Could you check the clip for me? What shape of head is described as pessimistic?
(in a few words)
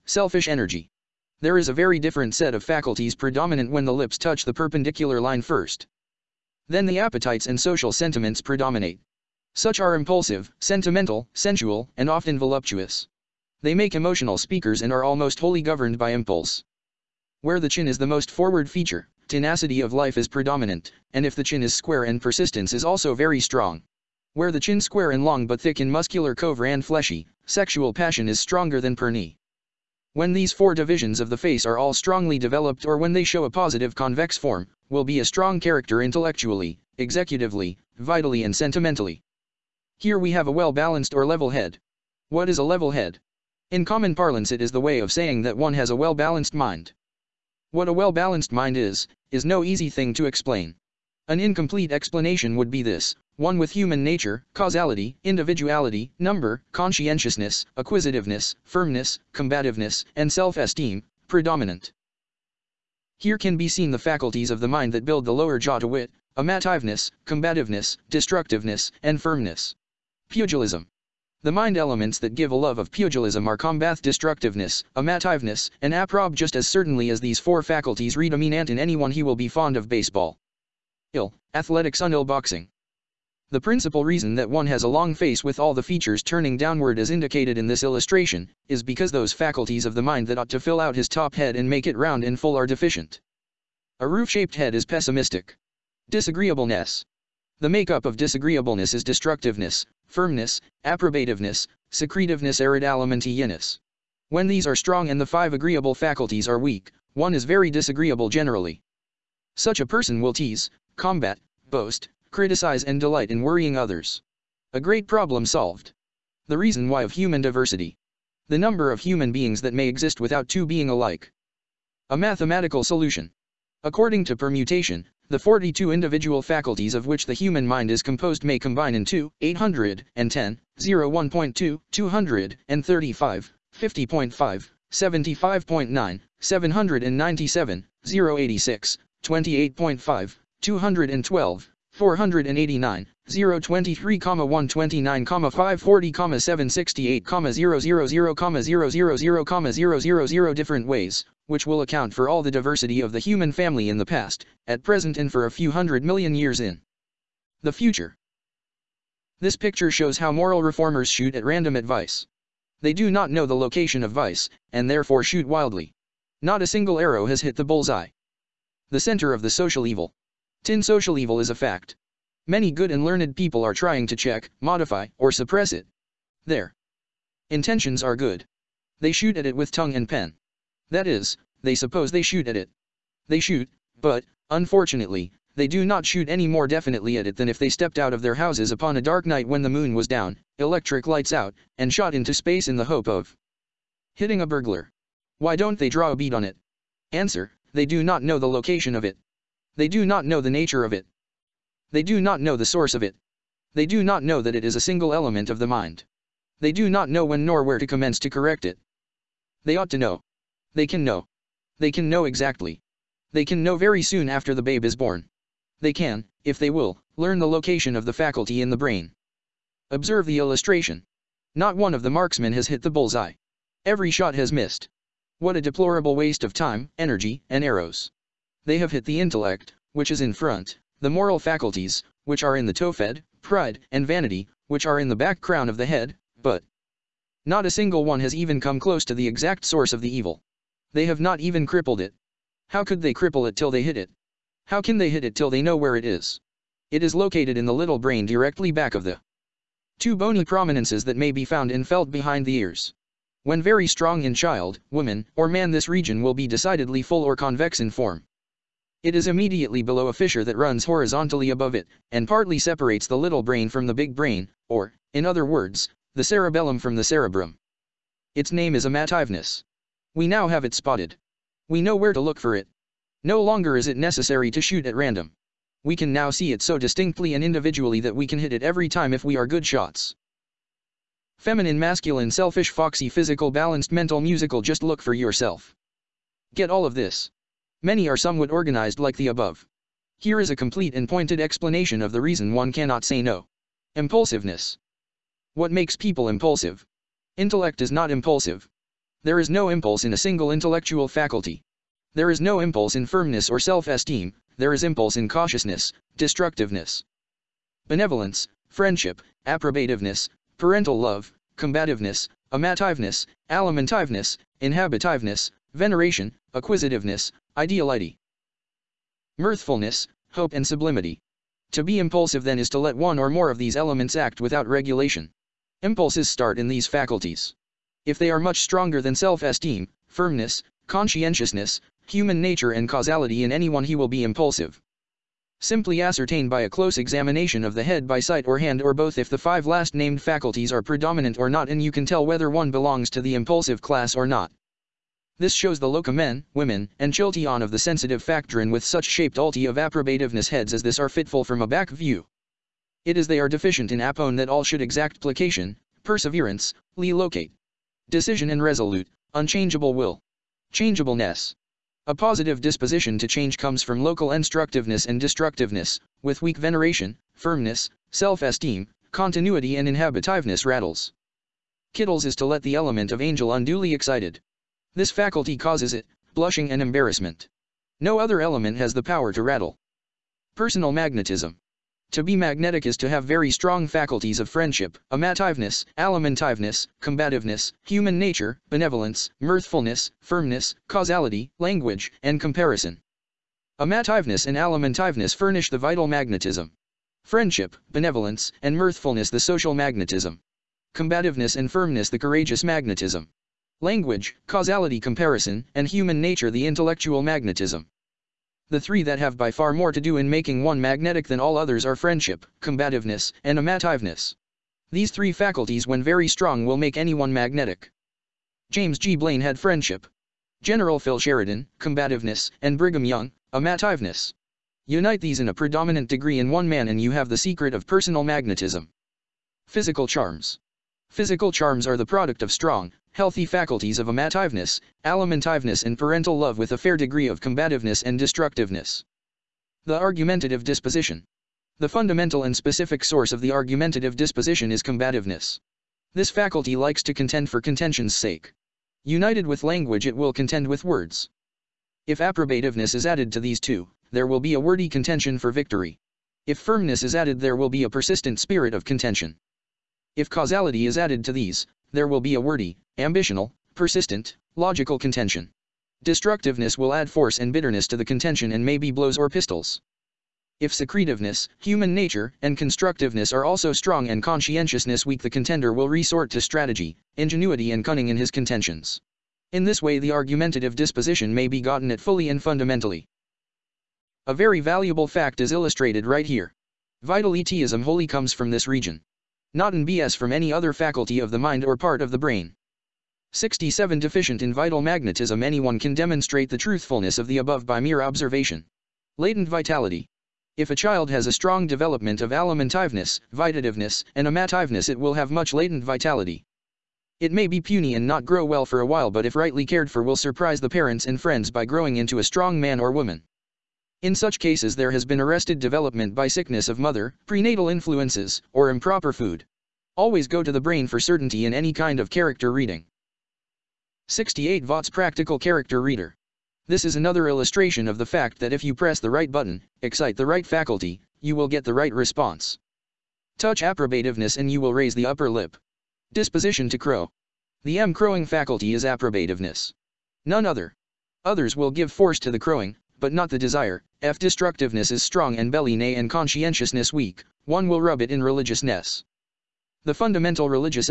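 Roof-shaped.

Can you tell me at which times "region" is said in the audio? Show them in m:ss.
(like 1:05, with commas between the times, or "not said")
4:15, 8:08.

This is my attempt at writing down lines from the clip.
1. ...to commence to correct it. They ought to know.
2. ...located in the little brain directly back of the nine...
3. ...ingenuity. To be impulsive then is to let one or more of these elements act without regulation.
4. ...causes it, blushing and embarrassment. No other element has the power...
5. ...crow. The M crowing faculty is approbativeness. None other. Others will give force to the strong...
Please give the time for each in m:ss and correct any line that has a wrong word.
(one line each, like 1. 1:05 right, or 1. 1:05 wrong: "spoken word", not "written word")
1. 3:27 right
2. 4:07 wrong: "two", not "nine"
3. 5:20 wrong: "sublimity", not "ingenuity"
4. 6:15 right
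5. 8:56 wrong: "crowing", not "strong".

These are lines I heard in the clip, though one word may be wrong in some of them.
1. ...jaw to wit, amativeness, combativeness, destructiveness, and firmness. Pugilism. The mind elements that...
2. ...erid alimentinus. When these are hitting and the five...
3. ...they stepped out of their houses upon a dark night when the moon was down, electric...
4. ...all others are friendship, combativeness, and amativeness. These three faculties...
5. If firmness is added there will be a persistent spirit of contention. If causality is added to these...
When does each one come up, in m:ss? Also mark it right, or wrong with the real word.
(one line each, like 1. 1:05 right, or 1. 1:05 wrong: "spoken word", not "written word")
1. 1:05 right
2. 1:42 wrong: "strong", not "hitting"
3. 3:07 right
4. 6:51 right
5. 7:36 right.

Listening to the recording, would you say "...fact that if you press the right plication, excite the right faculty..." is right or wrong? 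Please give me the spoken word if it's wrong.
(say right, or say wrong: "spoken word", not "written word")
wrong: "button", not "plication".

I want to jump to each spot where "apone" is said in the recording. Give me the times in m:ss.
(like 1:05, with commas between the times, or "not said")
5:53.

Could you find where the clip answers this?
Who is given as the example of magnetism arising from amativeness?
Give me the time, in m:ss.
7:02.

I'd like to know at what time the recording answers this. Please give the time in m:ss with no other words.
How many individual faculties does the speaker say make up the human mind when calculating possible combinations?
2:05.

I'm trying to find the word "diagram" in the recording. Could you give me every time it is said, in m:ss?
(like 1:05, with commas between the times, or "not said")
not said.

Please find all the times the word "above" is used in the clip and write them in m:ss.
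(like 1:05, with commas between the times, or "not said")
4:21, 4:49, 8:17.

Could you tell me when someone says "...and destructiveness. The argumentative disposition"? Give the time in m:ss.
7:18.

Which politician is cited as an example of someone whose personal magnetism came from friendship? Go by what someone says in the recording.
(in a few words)
James G. Blaine.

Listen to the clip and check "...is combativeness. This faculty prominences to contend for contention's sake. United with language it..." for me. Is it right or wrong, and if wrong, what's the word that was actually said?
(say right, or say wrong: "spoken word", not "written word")
wrong: "likes", not "prominences".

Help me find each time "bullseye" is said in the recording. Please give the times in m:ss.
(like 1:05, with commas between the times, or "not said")
2:47, 3:42.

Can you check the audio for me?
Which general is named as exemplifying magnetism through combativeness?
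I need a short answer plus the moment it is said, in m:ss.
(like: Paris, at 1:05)
Phil Sheridan, at 7:00.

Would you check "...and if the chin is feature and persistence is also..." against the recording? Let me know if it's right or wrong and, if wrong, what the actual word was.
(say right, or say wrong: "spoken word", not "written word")
wrong: "square", not "feature".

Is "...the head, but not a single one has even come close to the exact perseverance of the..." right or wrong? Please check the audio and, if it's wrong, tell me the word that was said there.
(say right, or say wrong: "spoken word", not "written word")
wrong: "source", not "perseverance".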